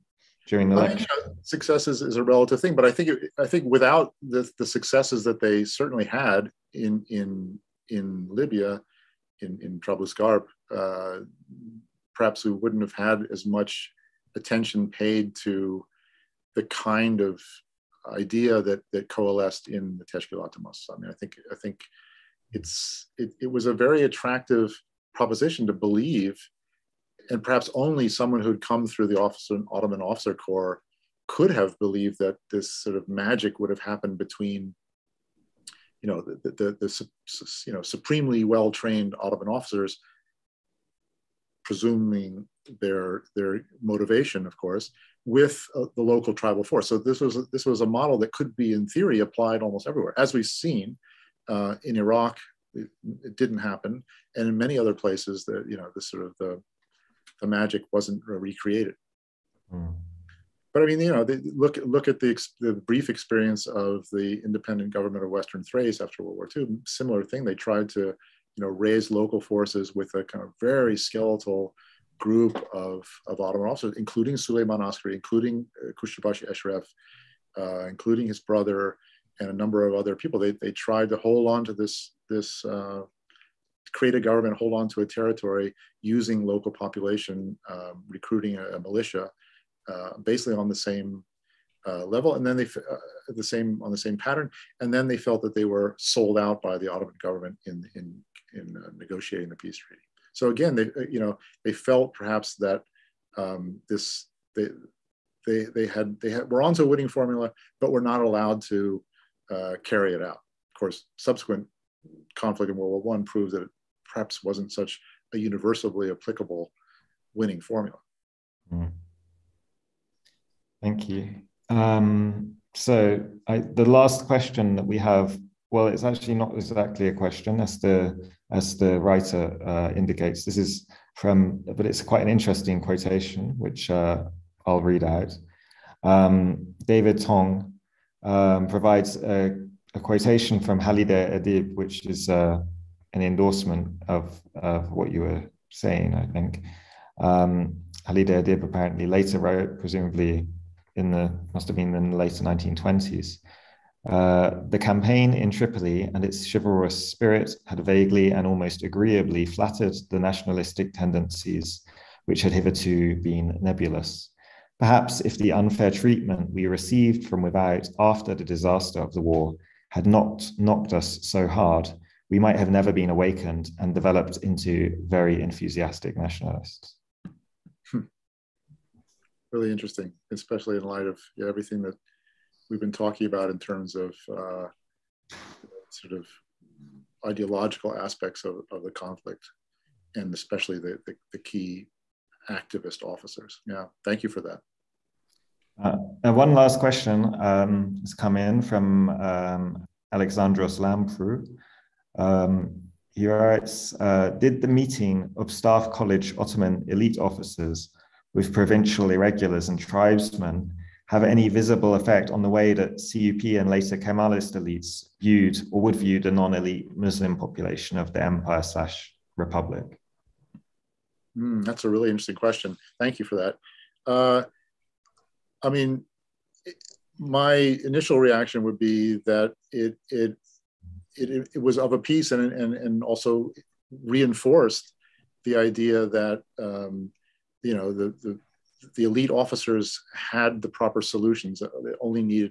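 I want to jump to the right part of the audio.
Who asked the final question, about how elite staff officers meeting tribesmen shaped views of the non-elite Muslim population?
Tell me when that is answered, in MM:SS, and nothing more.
03:20.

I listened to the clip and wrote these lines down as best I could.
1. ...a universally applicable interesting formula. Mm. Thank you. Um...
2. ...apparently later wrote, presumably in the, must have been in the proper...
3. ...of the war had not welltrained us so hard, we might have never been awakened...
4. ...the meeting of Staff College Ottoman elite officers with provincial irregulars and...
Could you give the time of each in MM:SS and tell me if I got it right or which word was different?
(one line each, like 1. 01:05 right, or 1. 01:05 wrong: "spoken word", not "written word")
1. 01:55 wrong: "winning", not "interesting"
2. 02:28 wrong: "later", not "proper"
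3. 02:49 wrong: "knocked", not "welltrained"
4. 03:24 right.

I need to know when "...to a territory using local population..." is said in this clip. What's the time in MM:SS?
01:24.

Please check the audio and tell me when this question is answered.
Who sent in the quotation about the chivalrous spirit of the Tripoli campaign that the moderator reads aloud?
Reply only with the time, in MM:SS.
02:16.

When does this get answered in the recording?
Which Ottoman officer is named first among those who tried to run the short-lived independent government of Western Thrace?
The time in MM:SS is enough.
01:14.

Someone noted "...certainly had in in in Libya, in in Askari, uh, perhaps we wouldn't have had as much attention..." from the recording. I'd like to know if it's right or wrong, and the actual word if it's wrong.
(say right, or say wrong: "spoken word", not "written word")
wrong: "Trablusgarp", not "Askari".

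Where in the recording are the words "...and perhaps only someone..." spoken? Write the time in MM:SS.
00:27.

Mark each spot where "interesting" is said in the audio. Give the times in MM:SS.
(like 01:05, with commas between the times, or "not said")
02:12, 02:59, 03:42.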